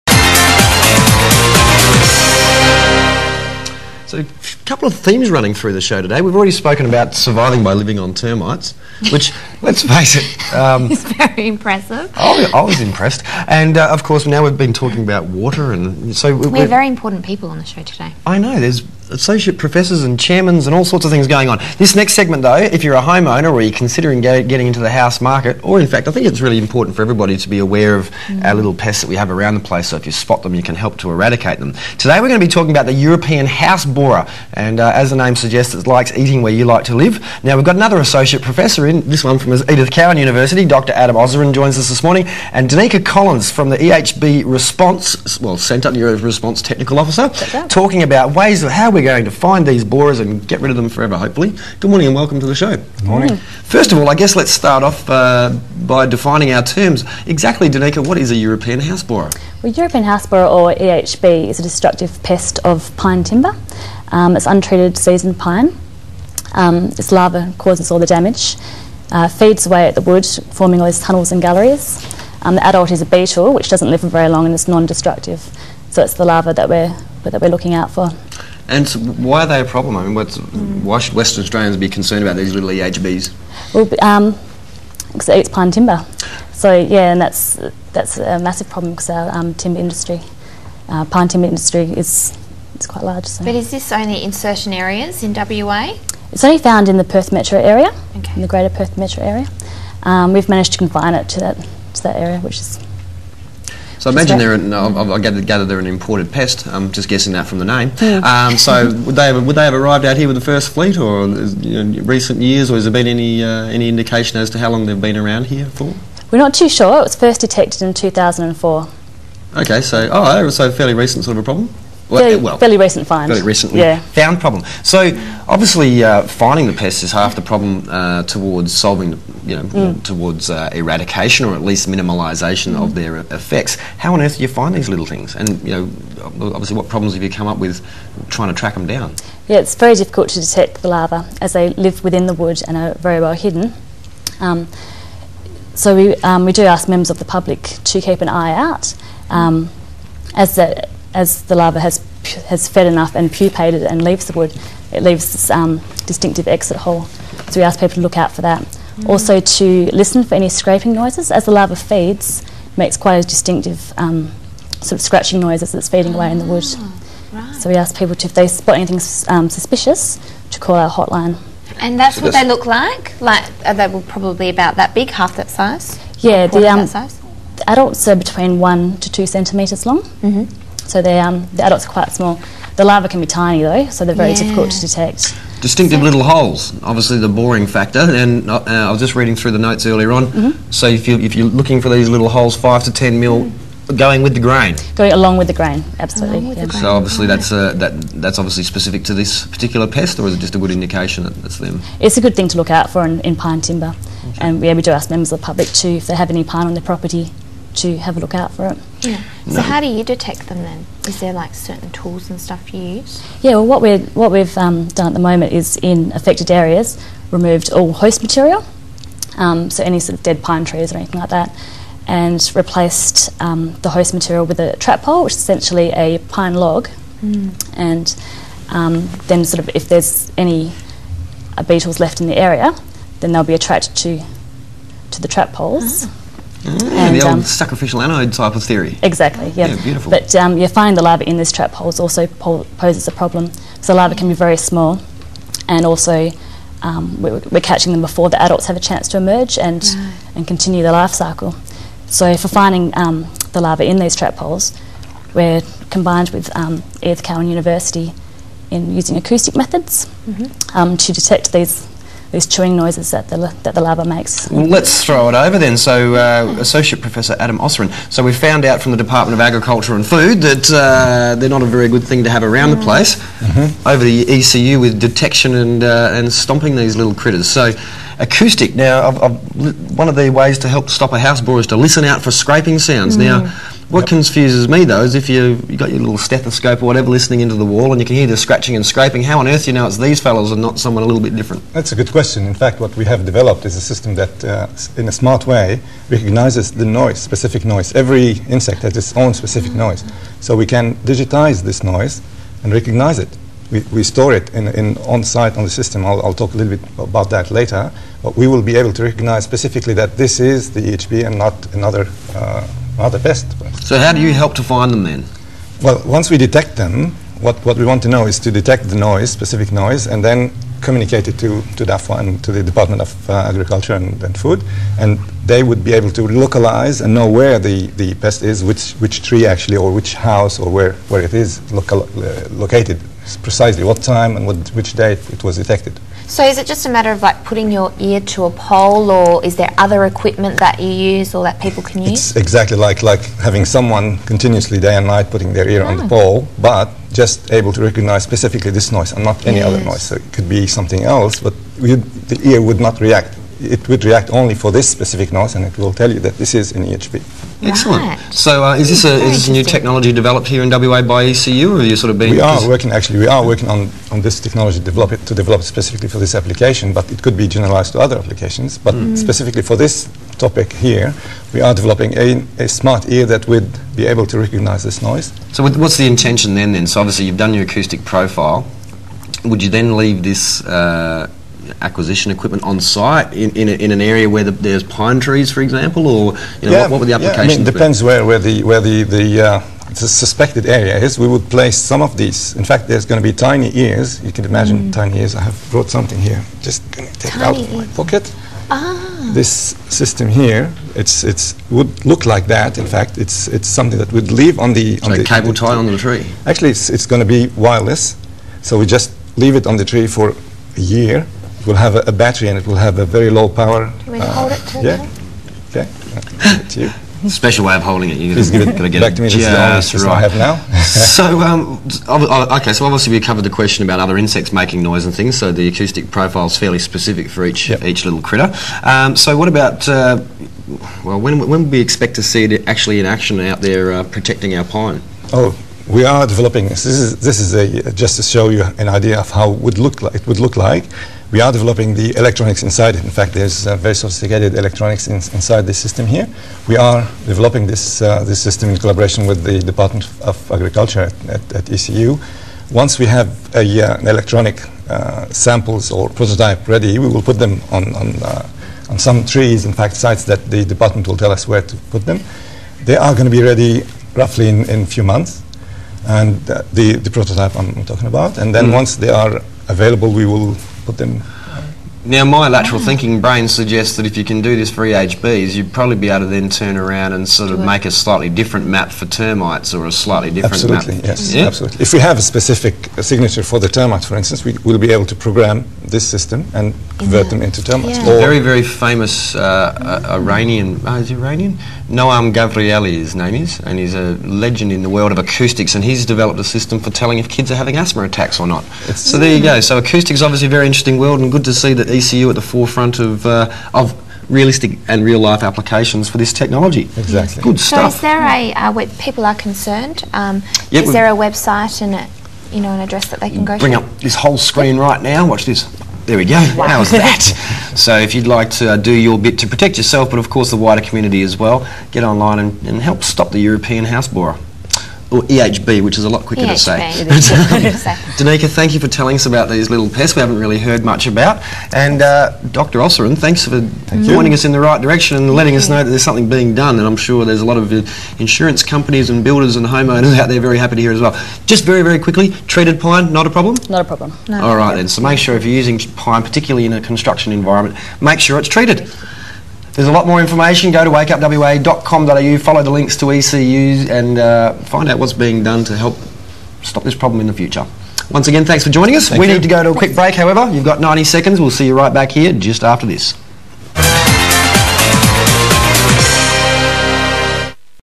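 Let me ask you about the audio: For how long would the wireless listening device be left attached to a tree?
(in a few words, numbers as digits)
a year.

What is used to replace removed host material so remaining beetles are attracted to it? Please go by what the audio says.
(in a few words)
trap pole.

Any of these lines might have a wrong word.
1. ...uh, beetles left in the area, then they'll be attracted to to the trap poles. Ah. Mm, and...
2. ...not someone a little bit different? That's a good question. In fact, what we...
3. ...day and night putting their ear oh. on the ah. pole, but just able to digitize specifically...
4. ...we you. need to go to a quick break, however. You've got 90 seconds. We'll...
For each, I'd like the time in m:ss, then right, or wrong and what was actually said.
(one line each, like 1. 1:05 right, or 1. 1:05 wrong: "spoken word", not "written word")
1. 3:51 right
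2. 4:50 right
3. 5:44 wrong: "recognize", not "digitize"
4. 9:19 right.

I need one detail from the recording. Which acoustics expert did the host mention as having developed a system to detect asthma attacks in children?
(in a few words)
Noam Gavrieli.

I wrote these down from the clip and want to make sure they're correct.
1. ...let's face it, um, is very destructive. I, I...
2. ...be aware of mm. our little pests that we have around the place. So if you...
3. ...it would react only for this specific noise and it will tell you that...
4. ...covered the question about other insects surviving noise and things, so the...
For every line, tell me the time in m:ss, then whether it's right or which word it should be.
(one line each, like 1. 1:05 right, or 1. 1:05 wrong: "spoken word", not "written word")
1. 0:09 wrong: "impressive", not "destructive"
2. 0:27 right
3. 5:53 right
4. 7:03 wrong: "making", not "surviving".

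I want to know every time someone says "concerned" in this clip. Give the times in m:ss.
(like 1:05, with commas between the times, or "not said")
1:21, 8:29.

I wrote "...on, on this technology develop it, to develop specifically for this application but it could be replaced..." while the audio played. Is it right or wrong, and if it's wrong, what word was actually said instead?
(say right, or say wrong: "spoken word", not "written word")
wrong: "generalized", not "replaced".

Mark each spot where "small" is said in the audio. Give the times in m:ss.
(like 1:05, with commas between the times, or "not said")
3:02, 4:04.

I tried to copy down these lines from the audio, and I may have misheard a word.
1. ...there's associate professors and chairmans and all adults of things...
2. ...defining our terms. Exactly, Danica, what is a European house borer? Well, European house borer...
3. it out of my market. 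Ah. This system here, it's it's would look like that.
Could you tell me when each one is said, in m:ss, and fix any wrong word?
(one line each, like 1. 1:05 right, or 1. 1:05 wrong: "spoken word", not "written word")
1. 0:18 wrong: "sorts", not "adults"
2. 0:56 right
3. 6:37 wrong: "pocket", not "market".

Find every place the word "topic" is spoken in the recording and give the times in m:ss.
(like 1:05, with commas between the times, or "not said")
6:10.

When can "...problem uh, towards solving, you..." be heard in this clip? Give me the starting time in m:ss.
2:07.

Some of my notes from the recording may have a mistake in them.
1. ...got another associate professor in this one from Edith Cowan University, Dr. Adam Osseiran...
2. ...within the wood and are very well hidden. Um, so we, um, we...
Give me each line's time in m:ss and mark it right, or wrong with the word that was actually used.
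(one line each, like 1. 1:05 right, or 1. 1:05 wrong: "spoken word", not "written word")
1. 0:37 right
2. 2:22 right.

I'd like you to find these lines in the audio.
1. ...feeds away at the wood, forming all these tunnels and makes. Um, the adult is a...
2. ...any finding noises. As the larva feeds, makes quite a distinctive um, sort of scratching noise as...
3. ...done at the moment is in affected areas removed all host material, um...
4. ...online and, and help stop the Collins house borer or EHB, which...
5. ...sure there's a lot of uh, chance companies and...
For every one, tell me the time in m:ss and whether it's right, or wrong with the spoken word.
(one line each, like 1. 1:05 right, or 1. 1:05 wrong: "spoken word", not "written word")
1. 1:09 wrong: "galleries", not "makes"
2. 2:40 wrong: "scraping", not "finding"
3. 3:34 right
4. 8:42 wrong: "European", not "Collins"
5. 8:56 wrong: "insurance", not "chance".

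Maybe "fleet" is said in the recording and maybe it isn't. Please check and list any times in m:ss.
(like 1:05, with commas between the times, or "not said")
1:50.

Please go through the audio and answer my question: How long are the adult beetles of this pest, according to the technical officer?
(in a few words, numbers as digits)
1 to 2 centimetres.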